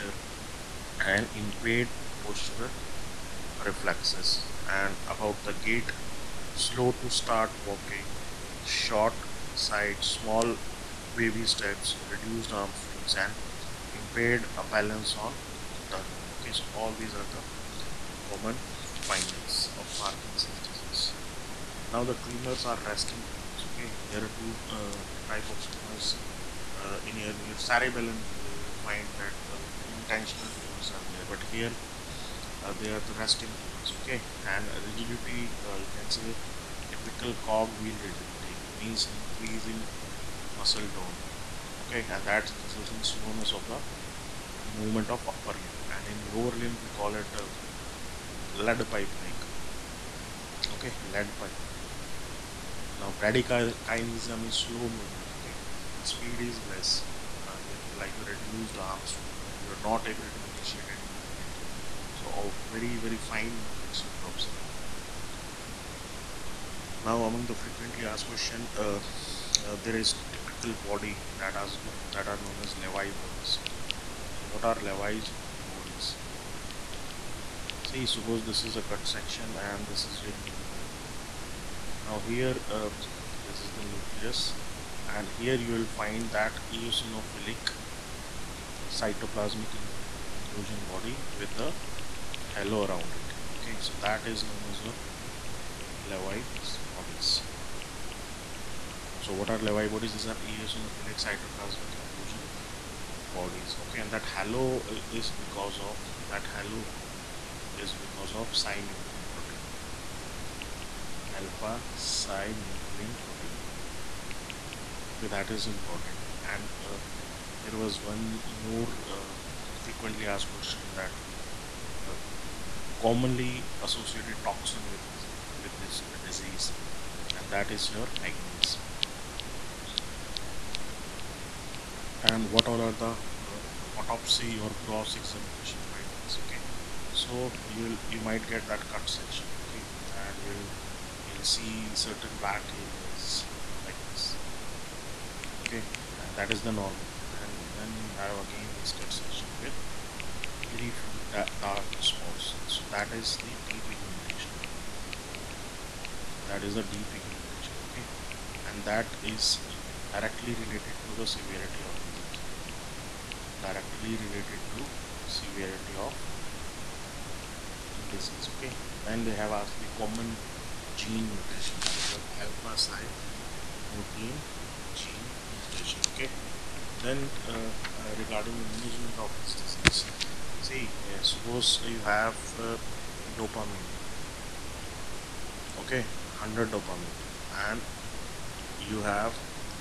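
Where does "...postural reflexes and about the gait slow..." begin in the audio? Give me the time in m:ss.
0:02.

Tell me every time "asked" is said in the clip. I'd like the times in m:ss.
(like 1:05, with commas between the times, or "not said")
1:08, 2:00, 2:49.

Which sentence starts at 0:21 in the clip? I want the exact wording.
Now the tremors are resting tremors.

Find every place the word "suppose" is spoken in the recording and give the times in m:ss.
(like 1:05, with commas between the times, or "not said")
1:18, 3:01.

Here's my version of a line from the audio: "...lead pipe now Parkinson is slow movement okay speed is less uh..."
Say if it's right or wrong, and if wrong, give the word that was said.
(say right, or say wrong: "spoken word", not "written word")
wrong: "Bradykinesia", not "Parkinson".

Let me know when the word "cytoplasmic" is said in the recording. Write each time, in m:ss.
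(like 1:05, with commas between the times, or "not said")
1:28, 1:41.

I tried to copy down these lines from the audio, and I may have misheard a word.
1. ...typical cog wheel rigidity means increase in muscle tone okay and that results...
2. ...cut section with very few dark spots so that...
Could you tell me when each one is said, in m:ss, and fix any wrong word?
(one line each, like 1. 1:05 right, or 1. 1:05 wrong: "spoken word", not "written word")
1. 0:36 right
2. 2:28 right.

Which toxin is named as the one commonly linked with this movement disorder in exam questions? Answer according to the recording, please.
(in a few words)
Manganese.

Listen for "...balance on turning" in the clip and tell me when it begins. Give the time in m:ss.
0:14.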